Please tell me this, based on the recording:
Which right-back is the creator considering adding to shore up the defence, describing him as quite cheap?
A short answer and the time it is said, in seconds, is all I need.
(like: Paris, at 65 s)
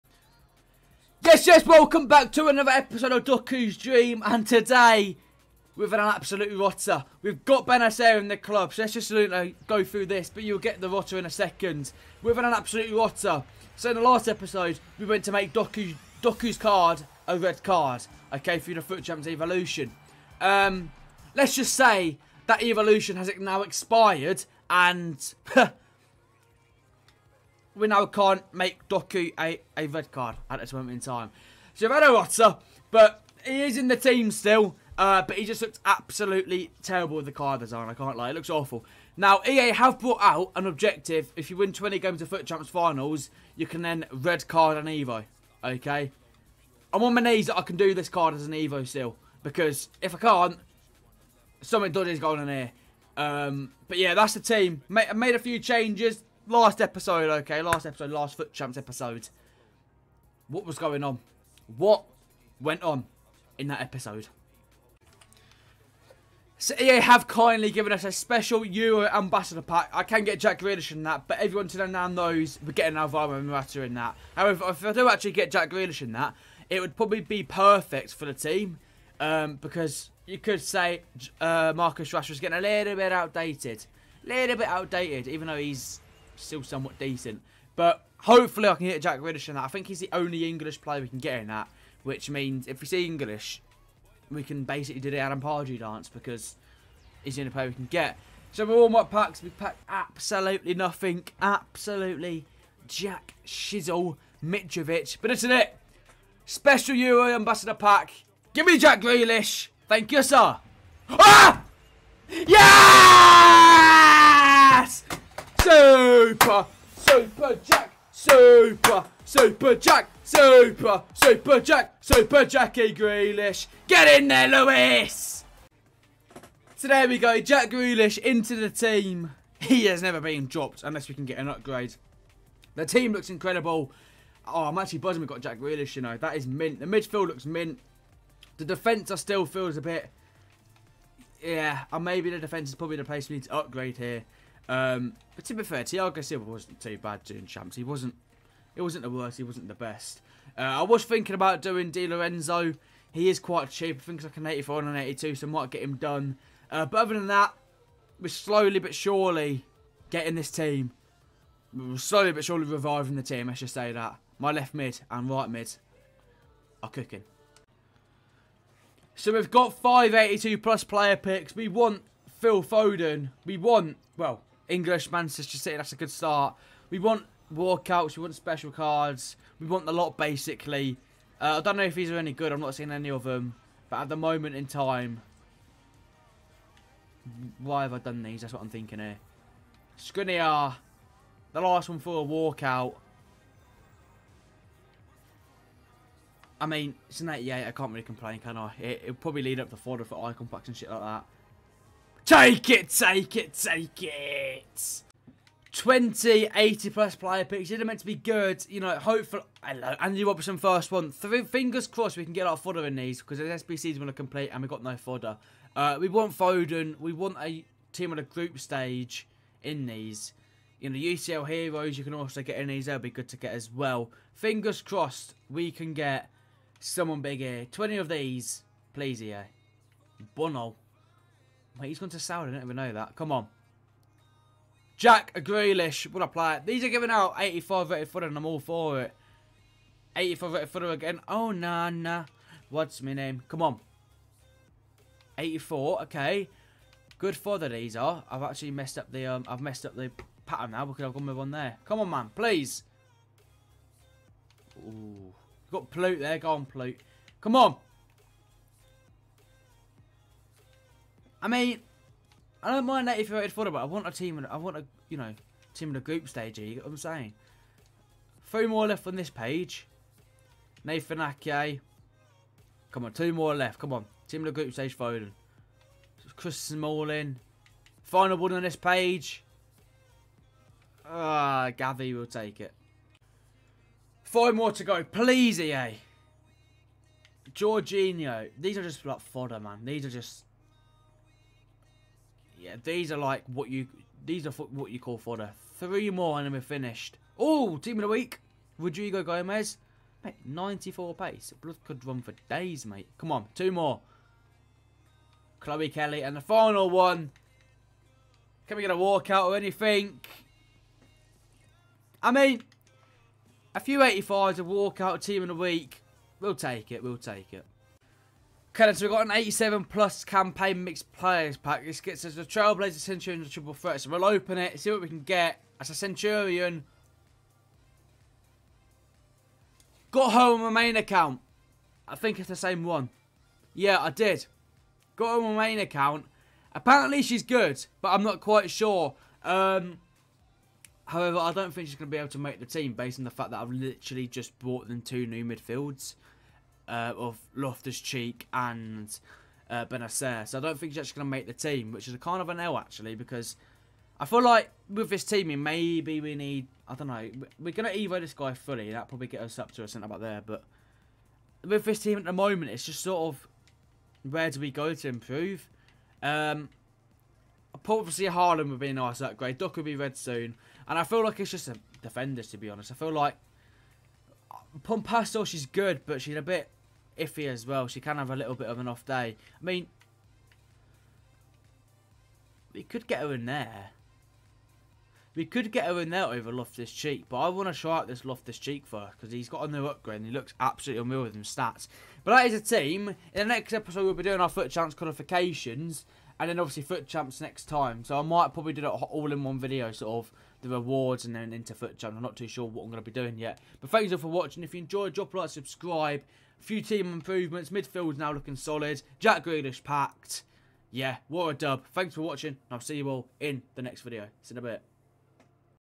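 Di Lorenzo, at 151 s.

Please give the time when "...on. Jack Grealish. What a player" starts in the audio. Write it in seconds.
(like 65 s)
233 s.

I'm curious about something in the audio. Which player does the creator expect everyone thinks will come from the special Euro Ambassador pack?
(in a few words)
Alvaro Morata.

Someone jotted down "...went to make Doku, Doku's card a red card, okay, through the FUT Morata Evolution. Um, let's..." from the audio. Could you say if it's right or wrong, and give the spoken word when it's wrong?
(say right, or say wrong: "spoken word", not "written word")
wrong: "Champs", not "Morata".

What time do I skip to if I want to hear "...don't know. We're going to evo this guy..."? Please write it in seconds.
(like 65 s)
356 s.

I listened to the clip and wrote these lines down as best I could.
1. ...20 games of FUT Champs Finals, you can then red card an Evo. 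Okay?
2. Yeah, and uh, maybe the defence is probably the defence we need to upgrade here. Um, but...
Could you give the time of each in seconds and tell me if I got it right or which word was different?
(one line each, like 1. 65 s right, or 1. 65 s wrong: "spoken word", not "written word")
1. 41 s right
2. 141 s wrong: "place", not "defence".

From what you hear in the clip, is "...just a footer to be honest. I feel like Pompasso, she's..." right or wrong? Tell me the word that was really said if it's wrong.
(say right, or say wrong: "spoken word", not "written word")
wrong: "defender", not "footer".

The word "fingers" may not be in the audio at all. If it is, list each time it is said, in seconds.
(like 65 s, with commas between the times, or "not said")
211 s, 224 s.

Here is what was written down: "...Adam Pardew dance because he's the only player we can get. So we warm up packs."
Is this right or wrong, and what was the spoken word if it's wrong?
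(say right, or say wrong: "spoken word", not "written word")
right.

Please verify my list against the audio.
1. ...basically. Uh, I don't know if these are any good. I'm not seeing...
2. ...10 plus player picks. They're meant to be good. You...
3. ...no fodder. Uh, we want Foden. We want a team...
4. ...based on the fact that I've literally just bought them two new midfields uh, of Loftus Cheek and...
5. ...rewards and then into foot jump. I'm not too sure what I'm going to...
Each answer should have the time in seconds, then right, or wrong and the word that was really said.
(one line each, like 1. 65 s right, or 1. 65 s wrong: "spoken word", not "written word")
1. 180 s right
2. 206 s wrong: "80", not "10"
3. 214 s right
4. 342 s right
5. 400 s right.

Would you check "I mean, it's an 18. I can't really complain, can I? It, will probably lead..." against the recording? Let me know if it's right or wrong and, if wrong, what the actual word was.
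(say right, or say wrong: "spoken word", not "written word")
wrong: "88", not "18".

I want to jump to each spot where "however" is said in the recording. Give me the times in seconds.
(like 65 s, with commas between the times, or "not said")
74 s, 341 s.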